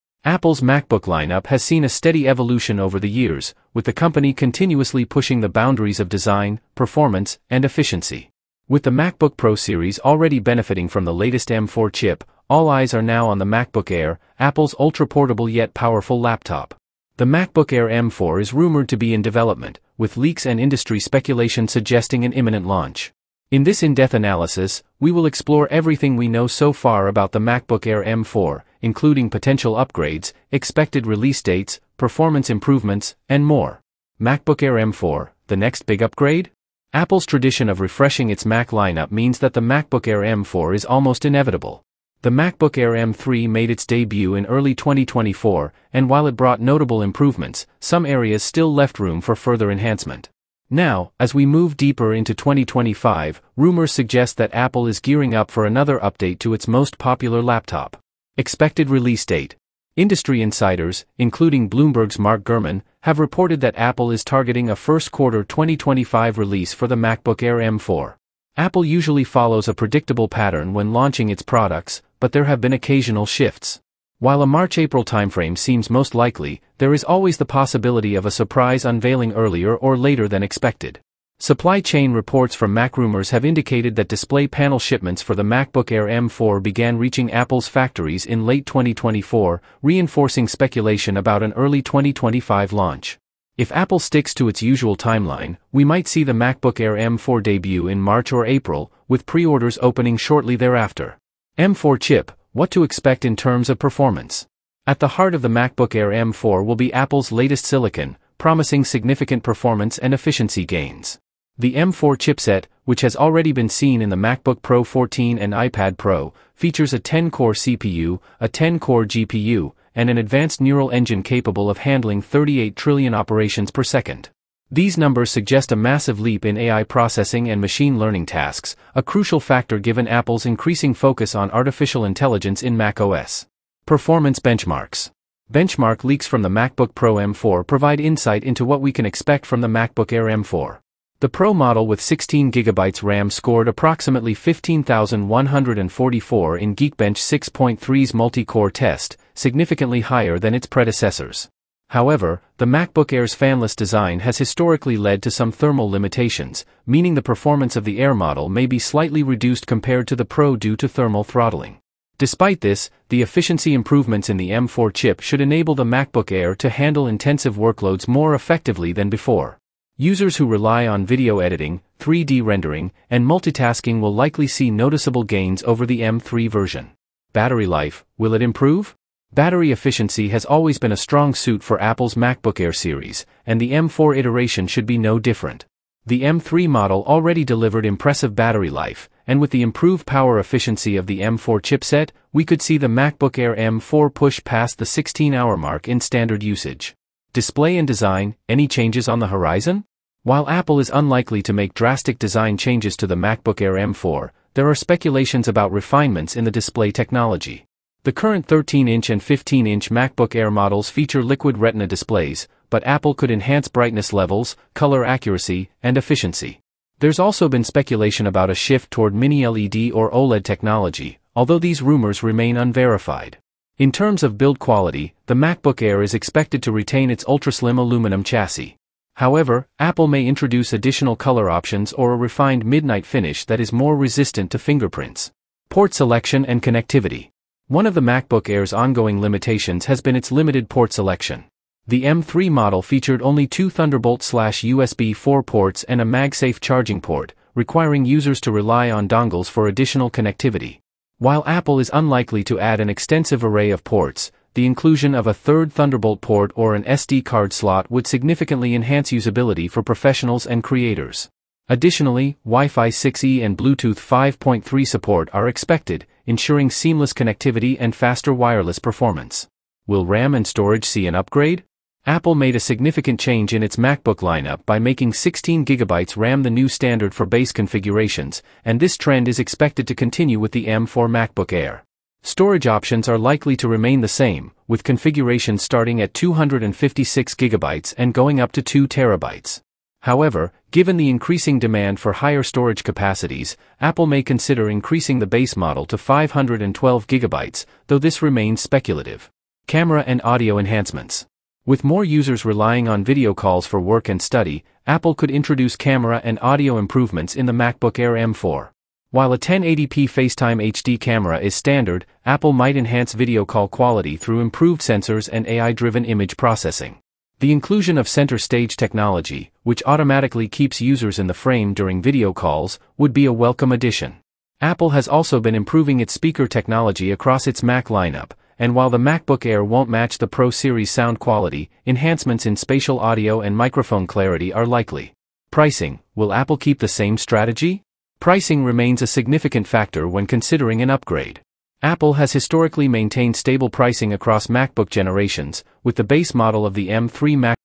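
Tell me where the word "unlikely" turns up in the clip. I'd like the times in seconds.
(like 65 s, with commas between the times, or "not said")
200 s, 251 s.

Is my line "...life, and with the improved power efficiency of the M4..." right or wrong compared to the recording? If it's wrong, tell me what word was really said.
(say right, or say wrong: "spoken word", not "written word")
right.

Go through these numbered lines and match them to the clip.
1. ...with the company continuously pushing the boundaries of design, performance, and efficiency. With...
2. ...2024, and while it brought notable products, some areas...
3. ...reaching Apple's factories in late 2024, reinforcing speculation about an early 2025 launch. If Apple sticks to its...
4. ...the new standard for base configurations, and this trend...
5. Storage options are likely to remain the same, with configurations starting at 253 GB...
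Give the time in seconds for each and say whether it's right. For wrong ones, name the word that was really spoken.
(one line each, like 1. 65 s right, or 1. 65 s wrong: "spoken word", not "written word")
1. 3 s right
2. 44 s wrong: "improvements", not "products"
3. 86 s right
4. 276 s right
5. 282 s wrong: "256", not "253".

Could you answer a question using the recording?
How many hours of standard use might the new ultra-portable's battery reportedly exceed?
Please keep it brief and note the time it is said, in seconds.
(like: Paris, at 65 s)
16, at 194 s.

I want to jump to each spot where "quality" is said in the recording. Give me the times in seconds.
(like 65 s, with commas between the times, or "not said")
224 s, 313 s, 331 s.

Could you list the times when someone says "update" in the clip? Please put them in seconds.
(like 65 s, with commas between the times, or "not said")
55 s.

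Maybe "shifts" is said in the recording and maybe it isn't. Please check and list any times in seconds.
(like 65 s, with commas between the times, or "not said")
73 s, 218 s.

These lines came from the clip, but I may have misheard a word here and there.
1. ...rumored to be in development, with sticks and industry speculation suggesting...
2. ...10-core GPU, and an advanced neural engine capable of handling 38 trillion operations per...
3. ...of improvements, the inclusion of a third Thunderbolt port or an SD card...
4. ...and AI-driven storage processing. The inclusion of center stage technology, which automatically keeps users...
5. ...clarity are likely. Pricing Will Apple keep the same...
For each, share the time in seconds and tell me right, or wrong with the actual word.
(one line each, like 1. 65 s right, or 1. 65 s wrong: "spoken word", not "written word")
1. 18 s wrong: "leaks", not "sticks"
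2. 118 s right
3. 253 s wrong: "ports", not "improvements"
4. 315 s wrong: "image", not "storage"
5. 334 s right.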